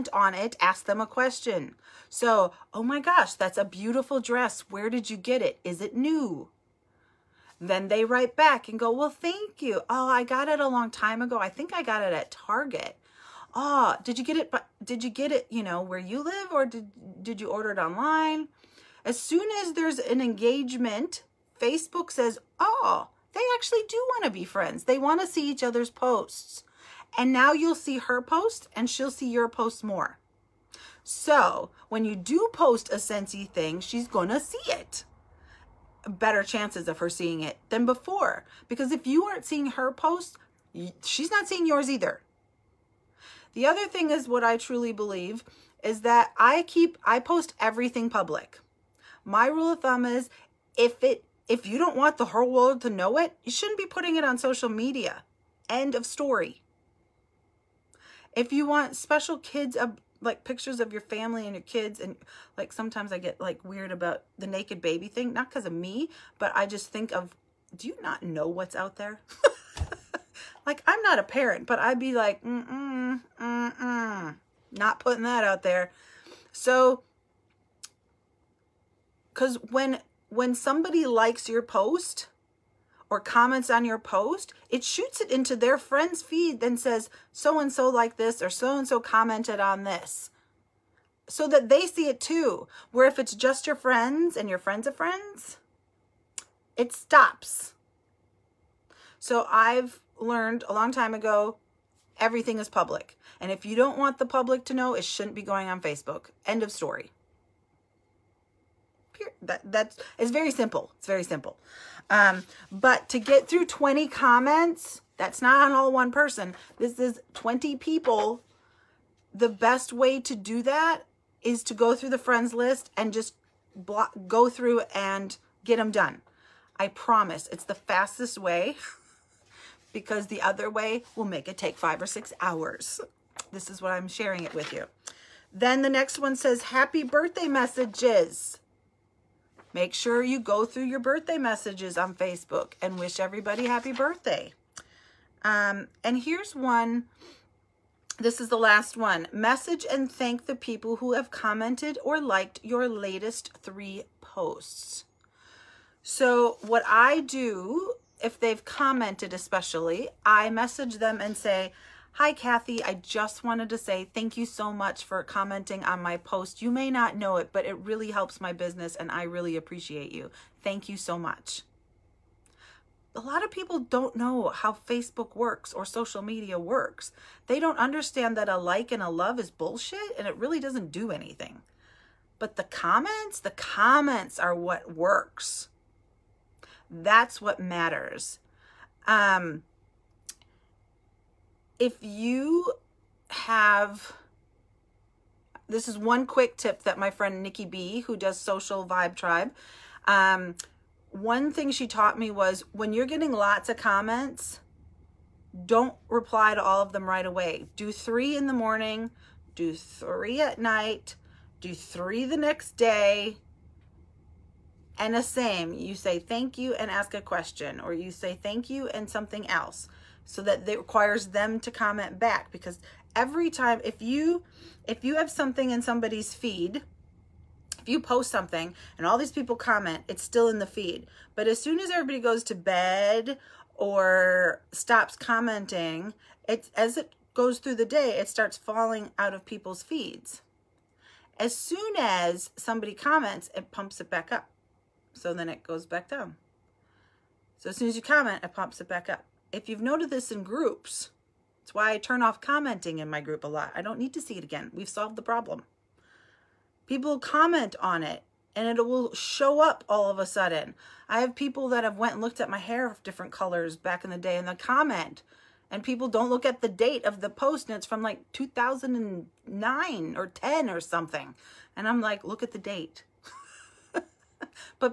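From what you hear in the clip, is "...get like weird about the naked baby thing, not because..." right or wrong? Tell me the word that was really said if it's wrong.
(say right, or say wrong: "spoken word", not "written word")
right.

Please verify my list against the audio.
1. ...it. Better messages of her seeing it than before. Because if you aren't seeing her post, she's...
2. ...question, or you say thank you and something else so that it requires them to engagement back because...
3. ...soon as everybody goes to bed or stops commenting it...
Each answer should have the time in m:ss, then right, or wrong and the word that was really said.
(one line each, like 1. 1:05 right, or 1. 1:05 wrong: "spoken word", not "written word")
1. 0:34 wrong: "chances", not "messages"
2. 3:37 wrong: "comment", not "engagement"
3. 3:51 right.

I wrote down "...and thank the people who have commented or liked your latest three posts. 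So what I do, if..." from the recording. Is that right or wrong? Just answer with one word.
right.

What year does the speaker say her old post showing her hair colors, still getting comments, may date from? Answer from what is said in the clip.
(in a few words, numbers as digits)
2009.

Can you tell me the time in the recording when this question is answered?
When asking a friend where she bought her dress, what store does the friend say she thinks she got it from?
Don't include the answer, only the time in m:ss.
0:12.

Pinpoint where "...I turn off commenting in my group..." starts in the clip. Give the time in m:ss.
4:11.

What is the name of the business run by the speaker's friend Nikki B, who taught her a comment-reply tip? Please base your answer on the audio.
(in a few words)
Social Vibe Tribe.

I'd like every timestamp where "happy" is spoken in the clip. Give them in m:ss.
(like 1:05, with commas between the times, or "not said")
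2:16, 2:23.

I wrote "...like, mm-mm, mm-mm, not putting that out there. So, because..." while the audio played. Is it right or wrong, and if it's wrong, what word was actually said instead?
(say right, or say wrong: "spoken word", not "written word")
right.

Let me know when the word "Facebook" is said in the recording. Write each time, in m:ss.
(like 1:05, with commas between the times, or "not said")
0:21, 1:45, 2:22, 2:54.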